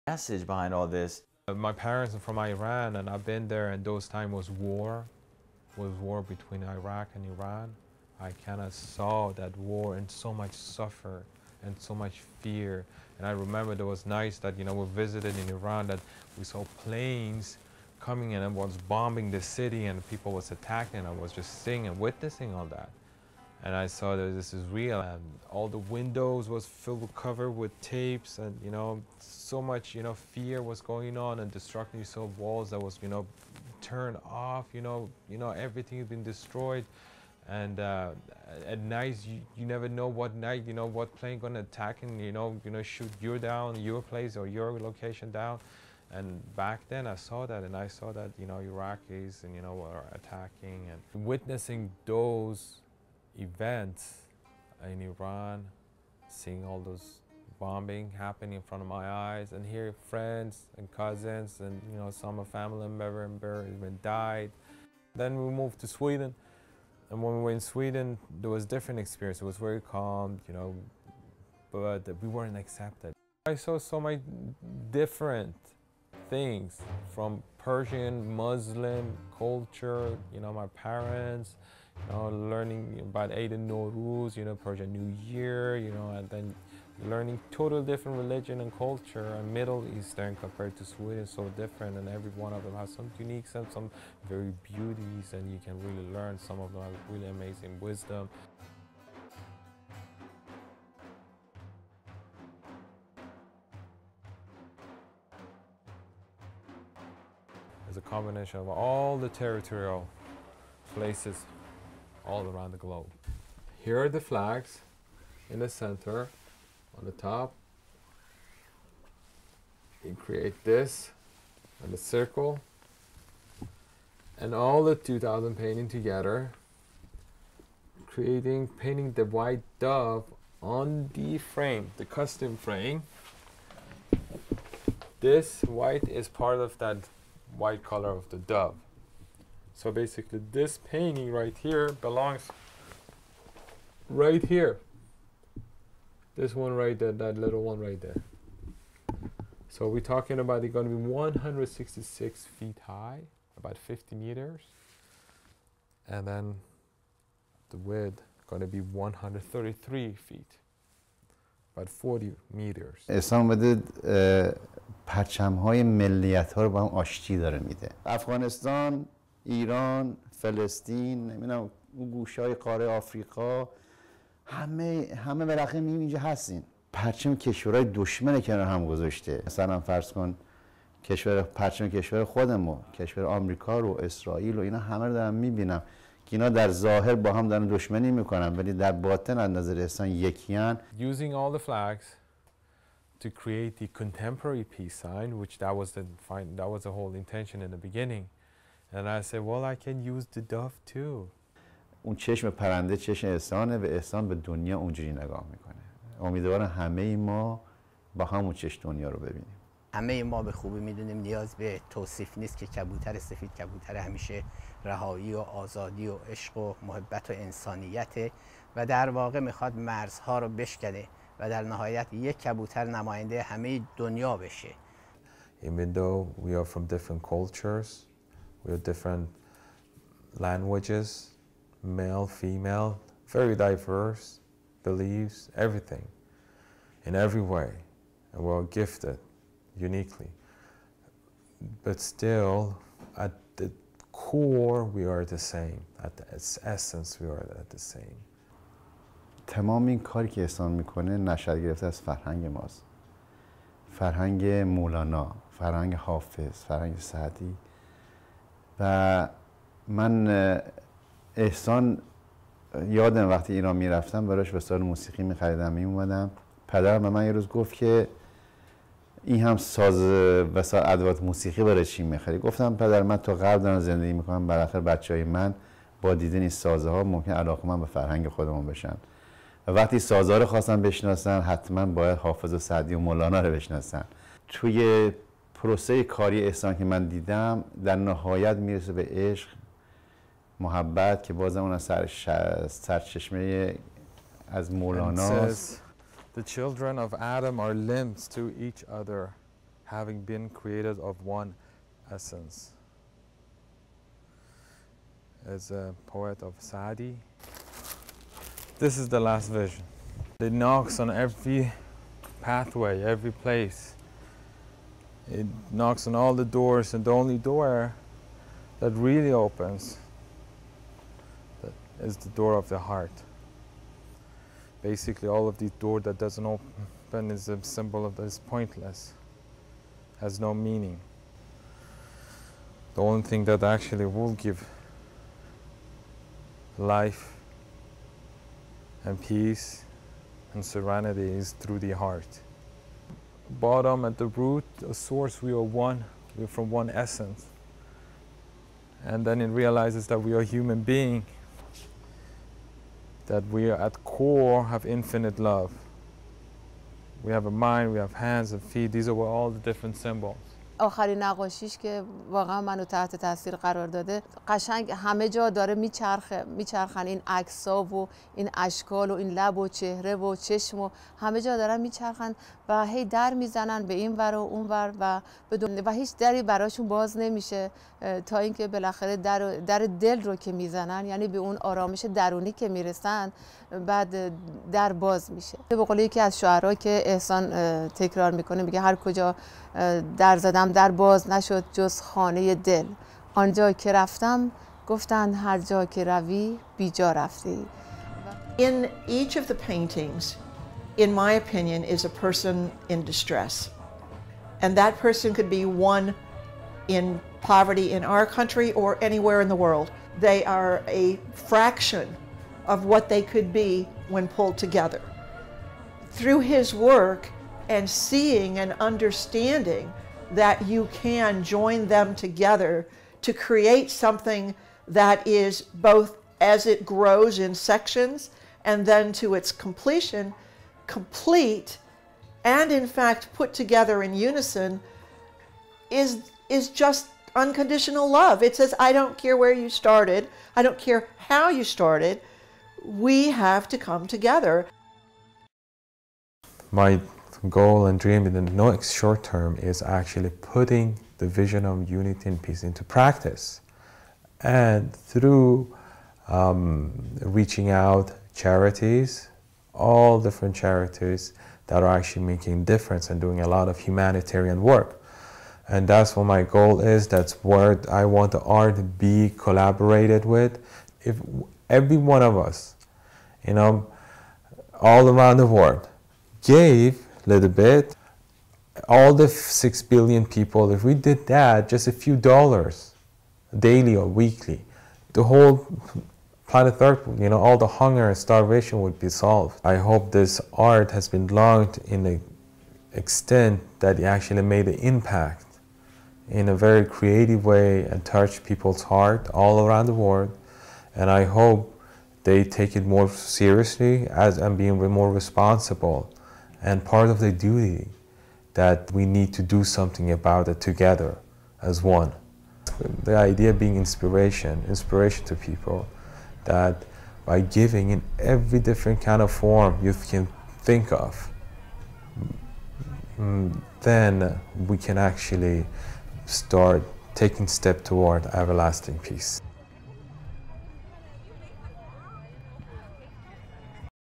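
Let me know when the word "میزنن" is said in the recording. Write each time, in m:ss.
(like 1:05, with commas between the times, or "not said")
6:13, 6:20.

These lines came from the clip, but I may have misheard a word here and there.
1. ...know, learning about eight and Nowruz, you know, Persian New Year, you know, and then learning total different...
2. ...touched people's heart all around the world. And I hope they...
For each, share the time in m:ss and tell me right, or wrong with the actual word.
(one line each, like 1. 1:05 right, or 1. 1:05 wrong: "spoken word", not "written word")
1. 1:22 right
2. 8:18 right.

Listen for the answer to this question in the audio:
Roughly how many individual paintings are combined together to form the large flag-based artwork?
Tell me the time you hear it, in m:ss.
2:04.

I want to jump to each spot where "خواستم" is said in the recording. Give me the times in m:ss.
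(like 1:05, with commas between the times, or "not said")
4:40.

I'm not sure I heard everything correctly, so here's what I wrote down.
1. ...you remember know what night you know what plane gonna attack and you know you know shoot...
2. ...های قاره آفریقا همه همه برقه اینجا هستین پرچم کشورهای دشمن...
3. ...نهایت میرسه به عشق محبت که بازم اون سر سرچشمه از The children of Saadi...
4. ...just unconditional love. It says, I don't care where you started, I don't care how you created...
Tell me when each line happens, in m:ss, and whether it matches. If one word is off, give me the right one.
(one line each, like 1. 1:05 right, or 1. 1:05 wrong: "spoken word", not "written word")
1. 0:39 wrong: "never", not "remember"
2. 2:52 right
3. 4:47 wrong: "Adam", not "Saadi"
4. 7:16 wrong: "started", not "created".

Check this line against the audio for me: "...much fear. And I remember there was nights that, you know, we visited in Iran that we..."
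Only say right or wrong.
right.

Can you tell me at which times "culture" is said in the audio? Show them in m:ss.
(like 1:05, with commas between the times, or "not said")
1:19, 1:28, 3:47.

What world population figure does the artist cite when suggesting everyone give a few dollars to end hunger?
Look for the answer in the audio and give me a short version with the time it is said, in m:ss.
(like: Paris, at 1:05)
6 billion, at 7:59.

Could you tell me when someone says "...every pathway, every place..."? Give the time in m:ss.
5:11.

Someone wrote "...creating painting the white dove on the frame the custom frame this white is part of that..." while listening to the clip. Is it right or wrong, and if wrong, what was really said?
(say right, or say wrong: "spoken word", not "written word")
right.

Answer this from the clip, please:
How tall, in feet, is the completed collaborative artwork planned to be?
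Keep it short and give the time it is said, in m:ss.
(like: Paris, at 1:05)
166 feet, at 2:31.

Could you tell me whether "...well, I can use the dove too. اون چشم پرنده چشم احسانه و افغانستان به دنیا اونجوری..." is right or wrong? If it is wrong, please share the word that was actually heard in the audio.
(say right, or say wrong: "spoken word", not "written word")
wrong: "احسان", not "افغانستان".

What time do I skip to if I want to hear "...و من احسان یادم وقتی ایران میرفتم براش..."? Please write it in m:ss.
4:18.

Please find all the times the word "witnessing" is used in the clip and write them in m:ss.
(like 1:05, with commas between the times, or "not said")
0:21, 0:51.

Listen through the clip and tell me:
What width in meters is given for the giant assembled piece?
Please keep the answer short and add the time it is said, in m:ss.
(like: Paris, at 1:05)
40 meters, at 2:41.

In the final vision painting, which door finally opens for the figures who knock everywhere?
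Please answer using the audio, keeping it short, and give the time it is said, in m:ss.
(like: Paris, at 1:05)
the door of the heart, at 5:22.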